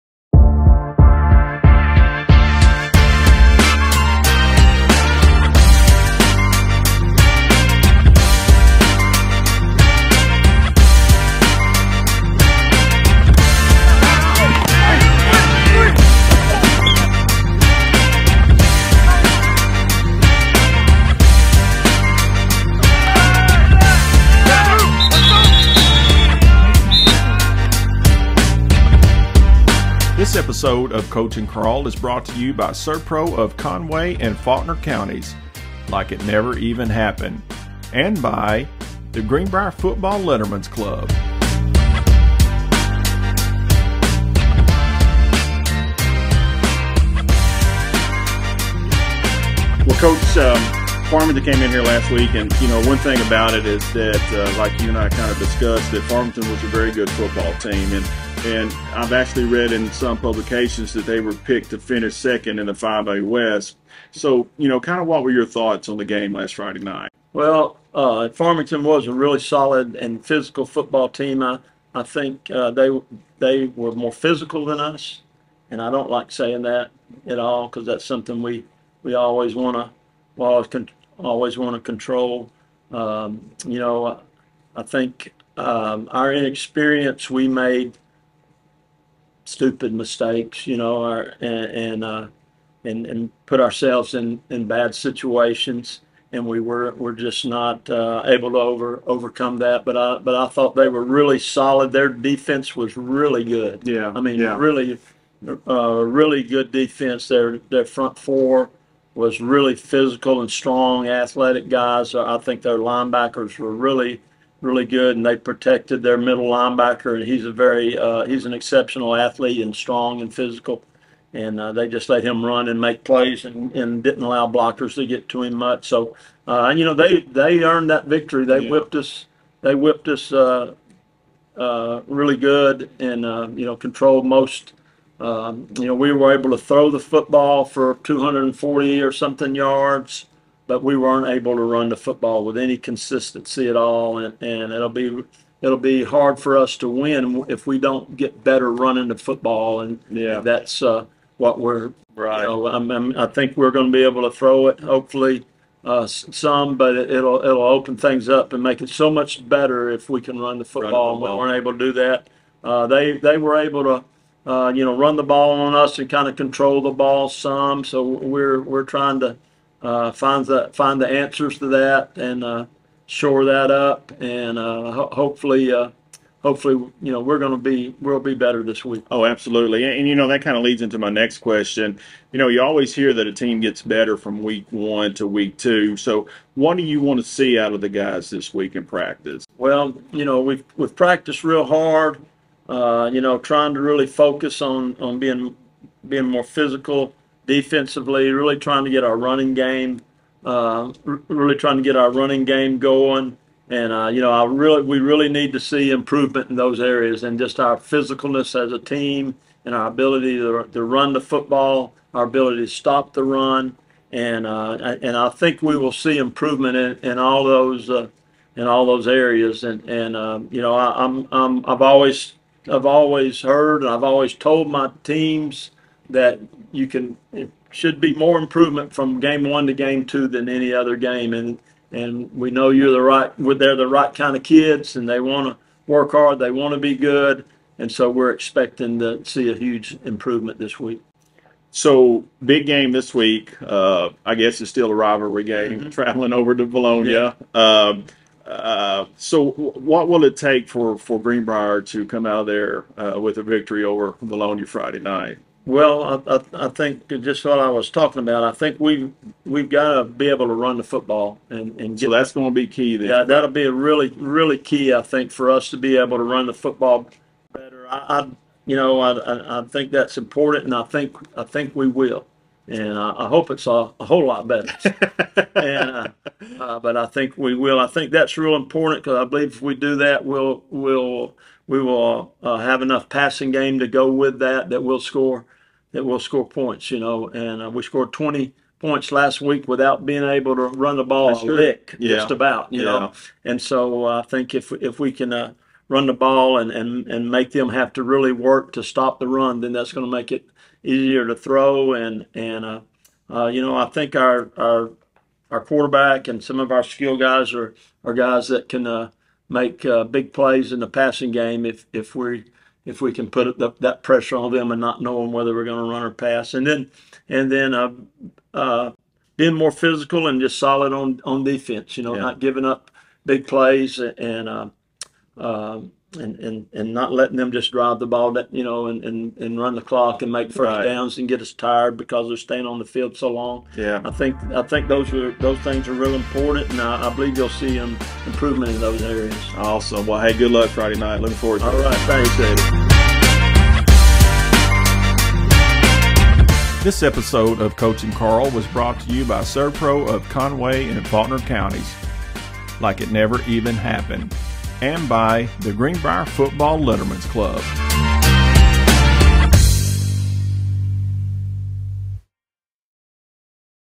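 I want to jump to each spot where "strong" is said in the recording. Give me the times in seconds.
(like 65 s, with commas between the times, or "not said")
110 s, 119 s.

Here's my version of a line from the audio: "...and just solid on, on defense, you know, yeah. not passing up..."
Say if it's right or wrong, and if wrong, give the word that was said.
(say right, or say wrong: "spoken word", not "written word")
wrong: "giving", not "passing".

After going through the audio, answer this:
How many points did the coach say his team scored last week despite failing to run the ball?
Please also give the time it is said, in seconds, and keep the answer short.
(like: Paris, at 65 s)
20, at 288 s.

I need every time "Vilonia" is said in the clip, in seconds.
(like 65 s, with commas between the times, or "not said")
246 s, 254 s.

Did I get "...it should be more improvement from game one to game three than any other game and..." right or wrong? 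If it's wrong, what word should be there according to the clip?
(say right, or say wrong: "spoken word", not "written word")
wrong: "two", not "three".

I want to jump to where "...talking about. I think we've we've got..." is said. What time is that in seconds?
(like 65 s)
257 s.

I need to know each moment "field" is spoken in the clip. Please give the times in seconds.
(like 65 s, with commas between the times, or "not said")
332 s.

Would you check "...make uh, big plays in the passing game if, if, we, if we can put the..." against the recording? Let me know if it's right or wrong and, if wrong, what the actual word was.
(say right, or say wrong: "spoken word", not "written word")
right.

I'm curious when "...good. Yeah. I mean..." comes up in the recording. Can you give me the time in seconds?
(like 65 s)
103 s.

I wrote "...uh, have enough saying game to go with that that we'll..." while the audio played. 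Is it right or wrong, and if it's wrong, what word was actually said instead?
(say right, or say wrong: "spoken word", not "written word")
wrong: "passing", not "saying".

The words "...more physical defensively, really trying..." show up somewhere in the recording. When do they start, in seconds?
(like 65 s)
196 s.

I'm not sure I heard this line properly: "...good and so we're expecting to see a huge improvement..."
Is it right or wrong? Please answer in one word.
right.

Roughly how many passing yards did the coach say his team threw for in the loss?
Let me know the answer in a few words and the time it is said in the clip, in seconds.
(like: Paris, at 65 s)
240, at 138 s.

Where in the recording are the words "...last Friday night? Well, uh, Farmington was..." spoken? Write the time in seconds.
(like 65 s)
66 s.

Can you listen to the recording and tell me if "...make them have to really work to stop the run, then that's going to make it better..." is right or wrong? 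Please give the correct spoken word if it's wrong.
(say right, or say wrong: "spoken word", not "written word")
wrong: "easier", not "better".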